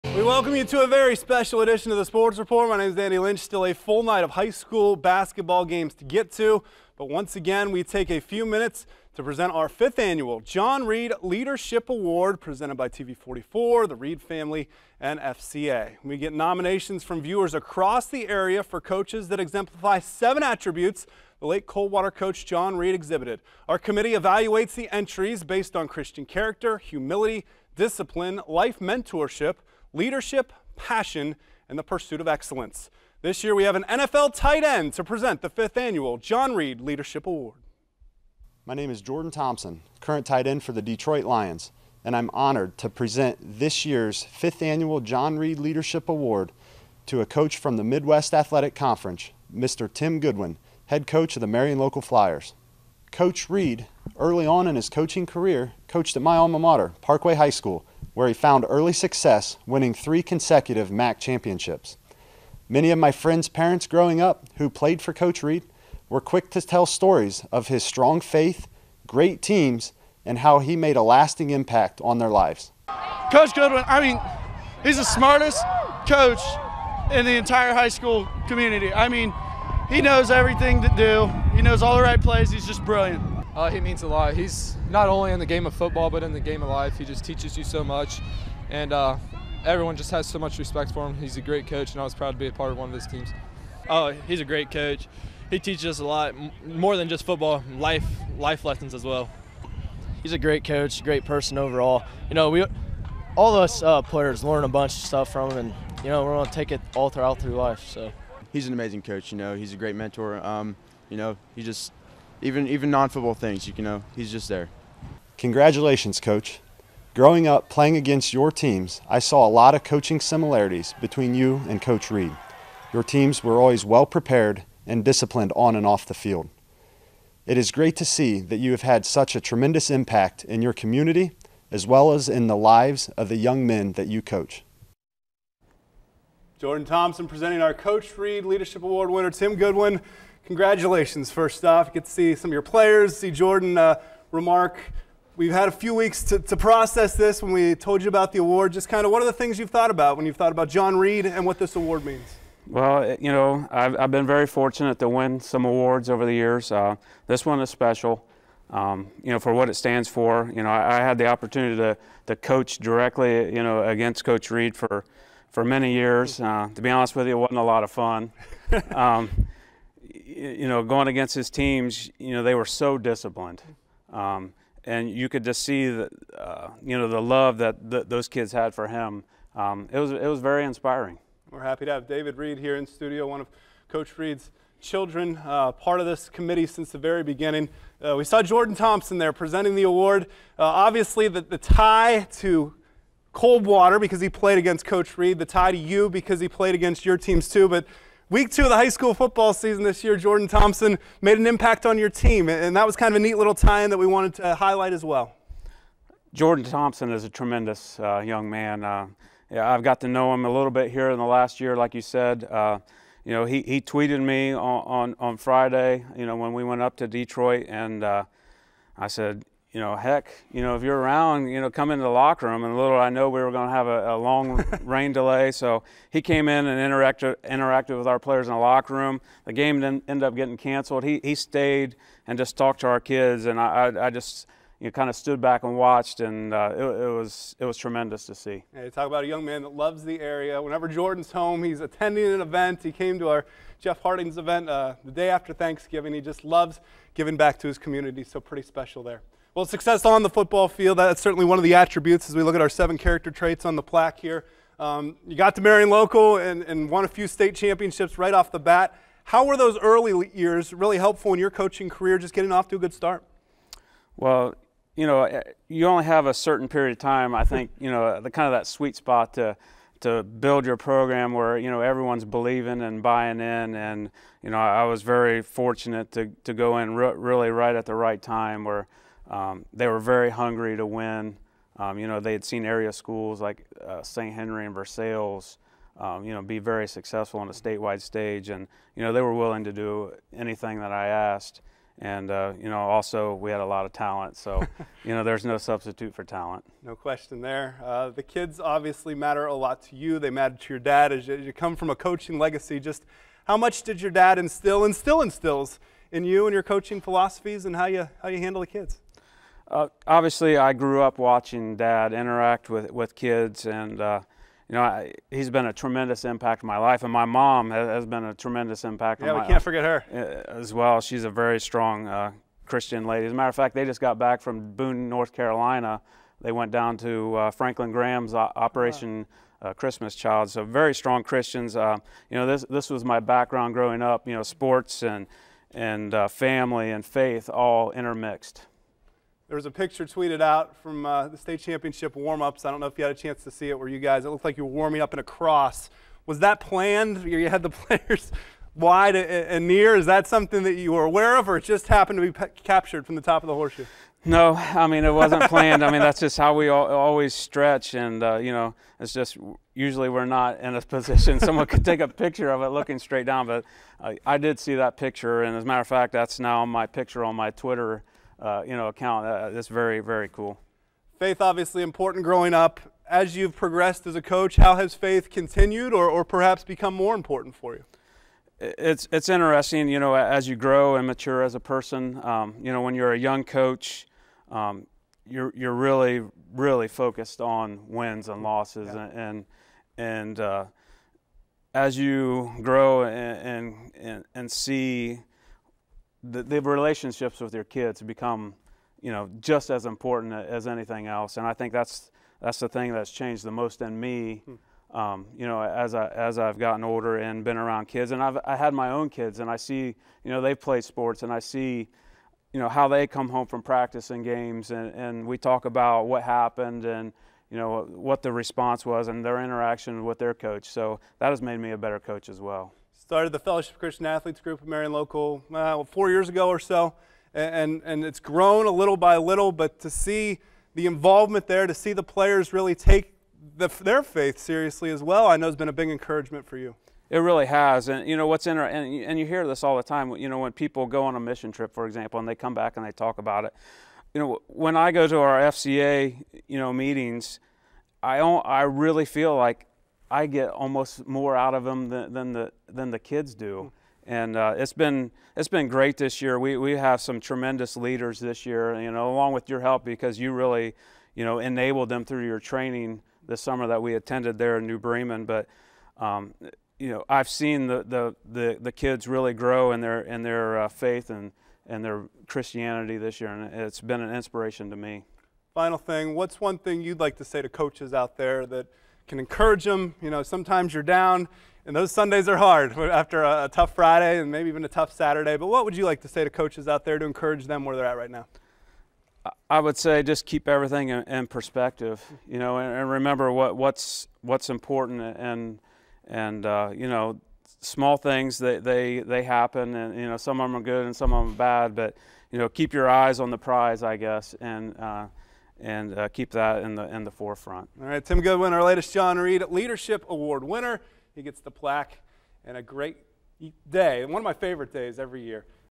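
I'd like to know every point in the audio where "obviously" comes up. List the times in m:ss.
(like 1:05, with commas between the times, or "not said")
3:10, 4:58, 5:10, 6:11.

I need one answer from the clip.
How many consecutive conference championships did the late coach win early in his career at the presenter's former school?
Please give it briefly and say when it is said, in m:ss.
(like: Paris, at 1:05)
3, at 0:59.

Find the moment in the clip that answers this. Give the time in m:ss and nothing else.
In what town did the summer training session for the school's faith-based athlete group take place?
7:44.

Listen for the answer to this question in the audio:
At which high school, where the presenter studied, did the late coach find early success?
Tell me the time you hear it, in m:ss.
0:57.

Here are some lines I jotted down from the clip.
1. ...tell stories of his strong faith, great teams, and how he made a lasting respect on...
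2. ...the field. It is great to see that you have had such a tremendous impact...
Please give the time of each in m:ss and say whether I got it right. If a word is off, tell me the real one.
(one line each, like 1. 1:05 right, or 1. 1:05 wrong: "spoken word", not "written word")
1. 1:06 wrong: "impact", not "respect"
2. 2:06 right.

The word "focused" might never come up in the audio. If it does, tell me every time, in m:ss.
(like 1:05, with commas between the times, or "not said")
6:26.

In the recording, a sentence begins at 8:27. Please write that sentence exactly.
All right, Tim Goodwin, our latest John Reed Leadership Award winner.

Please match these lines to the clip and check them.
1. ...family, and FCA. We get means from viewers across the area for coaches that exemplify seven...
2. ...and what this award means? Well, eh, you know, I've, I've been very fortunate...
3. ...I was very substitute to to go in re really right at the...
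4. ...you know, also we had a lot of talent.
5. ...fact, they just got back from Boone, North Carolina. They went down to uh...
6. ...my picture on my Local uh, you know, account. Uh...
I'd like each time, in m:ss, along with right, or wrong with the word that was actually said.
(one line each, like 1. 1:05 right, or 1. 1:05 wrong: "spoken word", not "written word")
1. 0:14 wrong: "nominations", not "means"
2. 2:31 right
3. 4:34 wrong: "fortunate", not "substitute"
4. 4:52 right
5. 5:23 right
6. 6:06 wrong: "Twitter", not "Local".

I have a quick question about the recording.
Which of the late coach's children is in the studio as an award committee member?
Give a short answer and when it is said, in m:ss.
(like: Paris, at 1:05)
David Reed, at 3:02.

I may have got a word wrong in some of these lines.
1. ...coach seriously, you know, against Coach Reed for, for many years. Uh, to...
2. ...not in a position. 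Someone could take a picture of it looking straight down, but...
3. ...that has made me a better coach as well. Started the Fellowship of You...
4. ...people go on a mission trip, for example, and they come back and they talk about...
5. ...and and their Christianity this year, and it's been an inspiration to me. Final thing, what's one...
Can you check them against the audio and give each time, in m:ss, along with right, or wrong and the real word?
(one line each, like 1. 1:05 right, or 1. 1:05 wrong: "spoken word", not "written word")
1. 2:42 wrong: "directly", not "seriously"
2. 6:00 right
3. 7:01 wrong: "Christian", not "You"
4. 7:20 right
5. 7:51 right.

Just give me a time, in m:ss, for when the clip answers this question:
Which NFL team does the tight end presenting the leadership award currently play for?
0:40.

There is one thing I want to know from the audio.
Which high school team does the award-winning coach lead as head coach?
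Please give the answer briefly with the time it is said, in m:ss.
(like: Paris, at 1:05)
Marion Local Flyers, at 0:51.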